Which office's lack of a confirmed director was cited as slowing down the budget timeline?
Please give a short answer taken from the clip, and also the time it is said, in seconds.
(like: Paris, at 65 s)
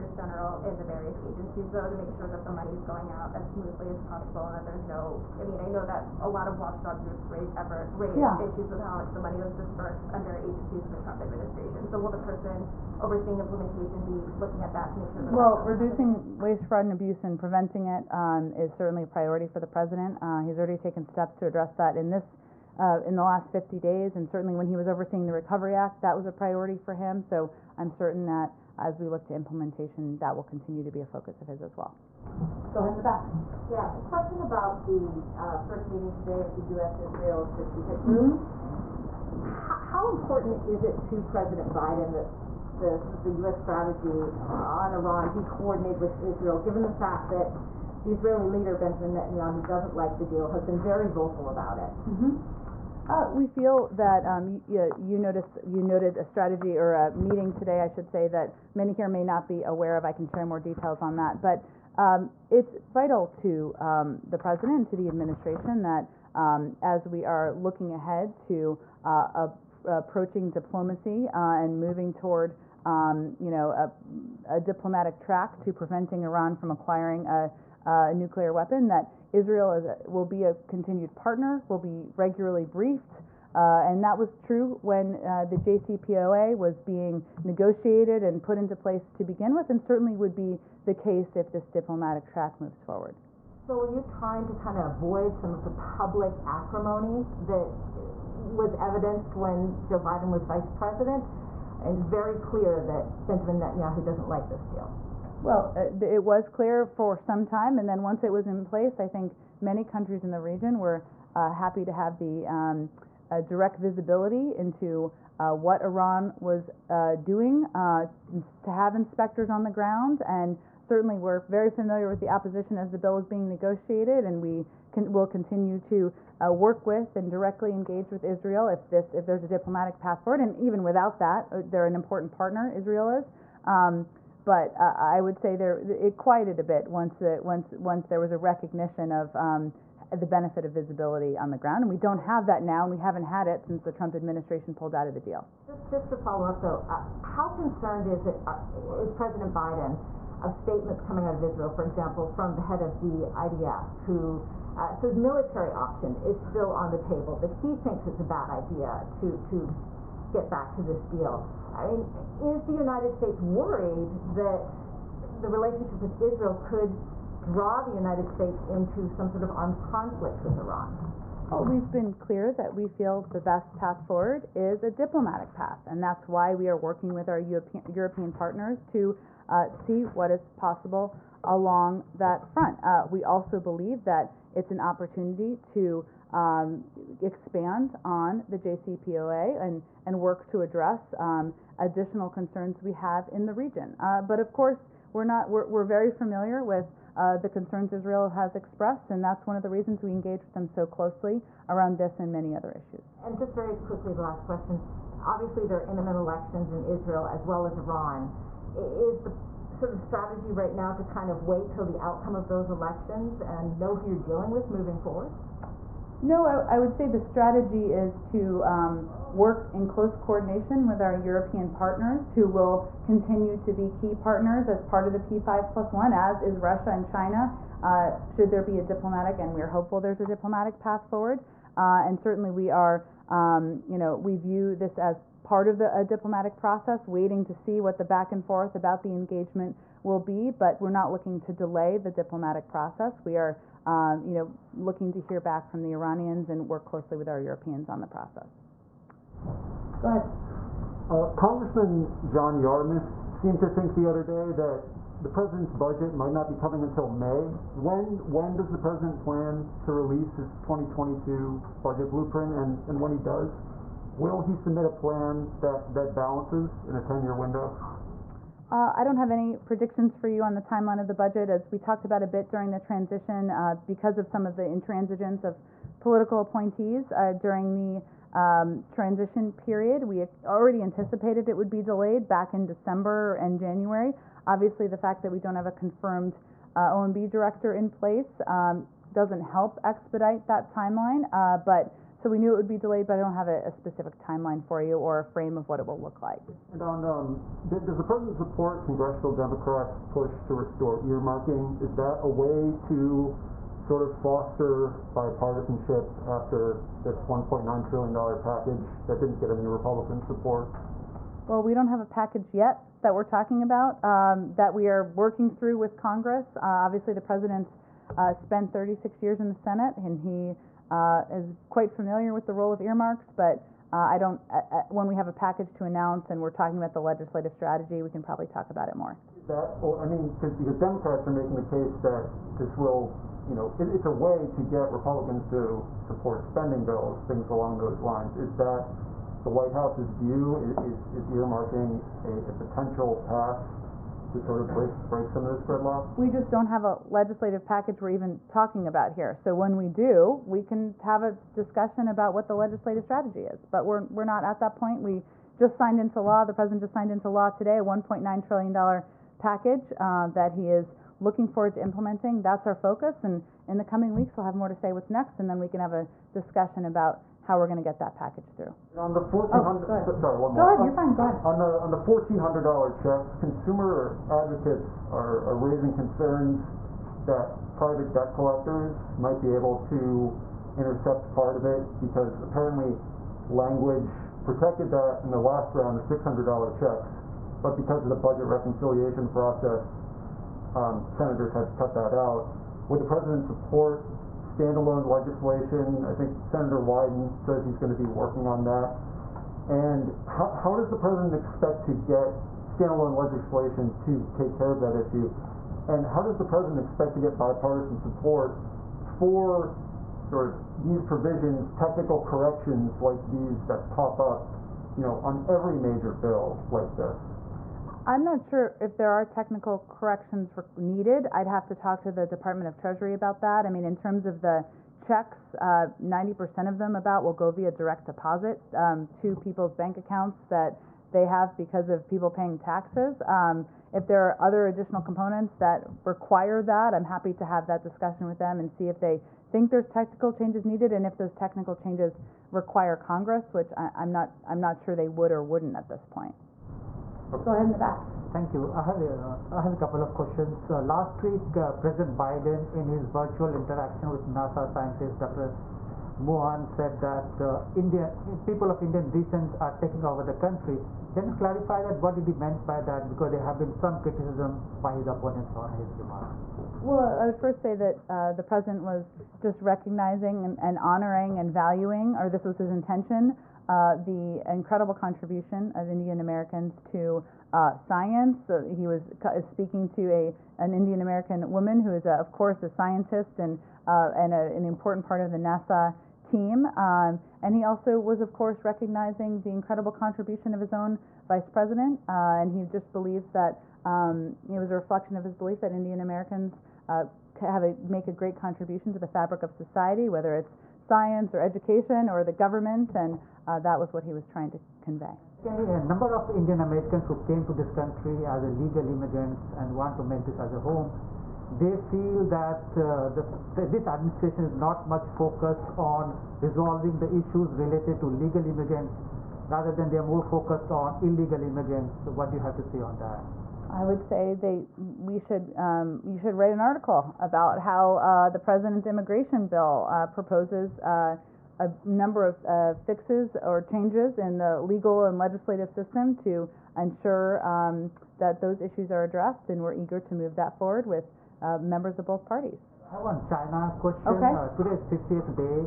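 OMB, at 286 s.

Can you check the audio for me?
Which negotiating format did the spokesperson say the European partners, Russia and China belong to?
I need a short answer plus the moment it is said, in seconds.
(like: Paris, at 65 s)
P5 plus one, at 225 s.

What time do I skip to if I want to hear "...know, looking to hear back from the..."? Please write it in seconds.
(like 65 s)
244 s.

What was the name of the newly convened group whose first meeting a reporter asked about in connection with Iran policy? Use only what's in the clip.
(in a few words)
U.S. Israel Strategic Group.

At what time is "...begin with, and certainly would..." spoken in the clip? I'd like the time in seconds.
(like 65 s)
89 s.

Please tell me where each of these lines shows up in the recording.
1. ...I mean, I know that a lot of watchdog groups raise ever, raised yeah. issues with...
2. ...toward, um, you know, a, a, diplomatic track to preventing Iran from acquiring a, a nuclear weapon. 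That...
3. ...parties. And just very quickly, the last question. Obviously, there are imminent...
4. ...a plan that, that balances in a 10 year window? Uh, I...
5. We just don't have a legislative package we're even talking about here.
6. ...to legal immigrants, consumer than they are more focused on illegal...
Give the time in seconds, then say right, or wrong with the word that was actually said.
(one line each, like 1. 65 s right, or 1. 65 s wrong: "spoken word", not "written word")
1. 5 s right
2. 72 s right
3. 202 s wrong: "issues", not "parties"
4. 264 s right
5. 346 s right
6. 517 s wrong: "rather", not "consumer".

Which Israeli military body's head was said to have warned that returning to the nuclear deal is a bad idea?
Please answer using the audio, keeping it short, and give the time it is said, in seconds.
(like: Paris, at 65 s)
IDF, at 153 s.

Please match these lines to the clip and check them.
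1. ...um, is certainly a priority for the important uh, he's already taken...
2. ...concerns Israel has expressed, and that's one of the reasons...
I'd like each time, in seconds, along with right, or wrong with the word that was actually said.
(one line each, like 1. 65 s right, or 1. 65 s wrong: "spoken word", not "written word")
1. 18 s wrong: "president", not "important"
2. 197 s right.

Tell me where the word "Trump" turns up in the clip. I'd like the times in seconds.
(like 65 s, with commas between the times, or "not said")
10 s, 143 s.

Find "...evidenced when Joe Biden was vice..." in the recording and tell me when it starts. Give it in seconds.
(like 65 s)
98 s.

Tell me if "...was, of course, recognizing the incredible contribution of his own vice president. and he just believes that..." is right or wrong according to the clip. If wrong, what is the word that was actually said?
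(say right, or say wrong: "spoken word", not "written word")
right.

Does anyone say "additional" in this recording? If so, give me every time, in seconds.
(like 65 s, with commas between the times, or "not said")
191 s, 434 s.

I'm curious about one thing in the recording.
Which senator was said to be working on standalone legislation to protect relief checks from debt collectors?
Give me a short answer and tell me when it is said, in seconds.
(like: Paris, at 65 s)
Wyden, at 396 s.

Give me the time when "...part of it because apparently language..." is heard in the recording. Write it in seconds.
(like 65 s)
381 s.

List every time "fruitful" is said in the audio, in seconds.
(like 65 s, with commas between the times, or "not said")
not said.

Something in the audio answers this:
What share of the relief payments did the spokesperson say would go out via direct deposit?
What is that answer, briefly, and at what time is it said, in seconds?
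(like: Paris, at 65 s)
90%, at 425 s.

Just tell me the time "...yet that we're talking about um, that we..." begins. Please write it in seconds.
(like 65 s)
312 s.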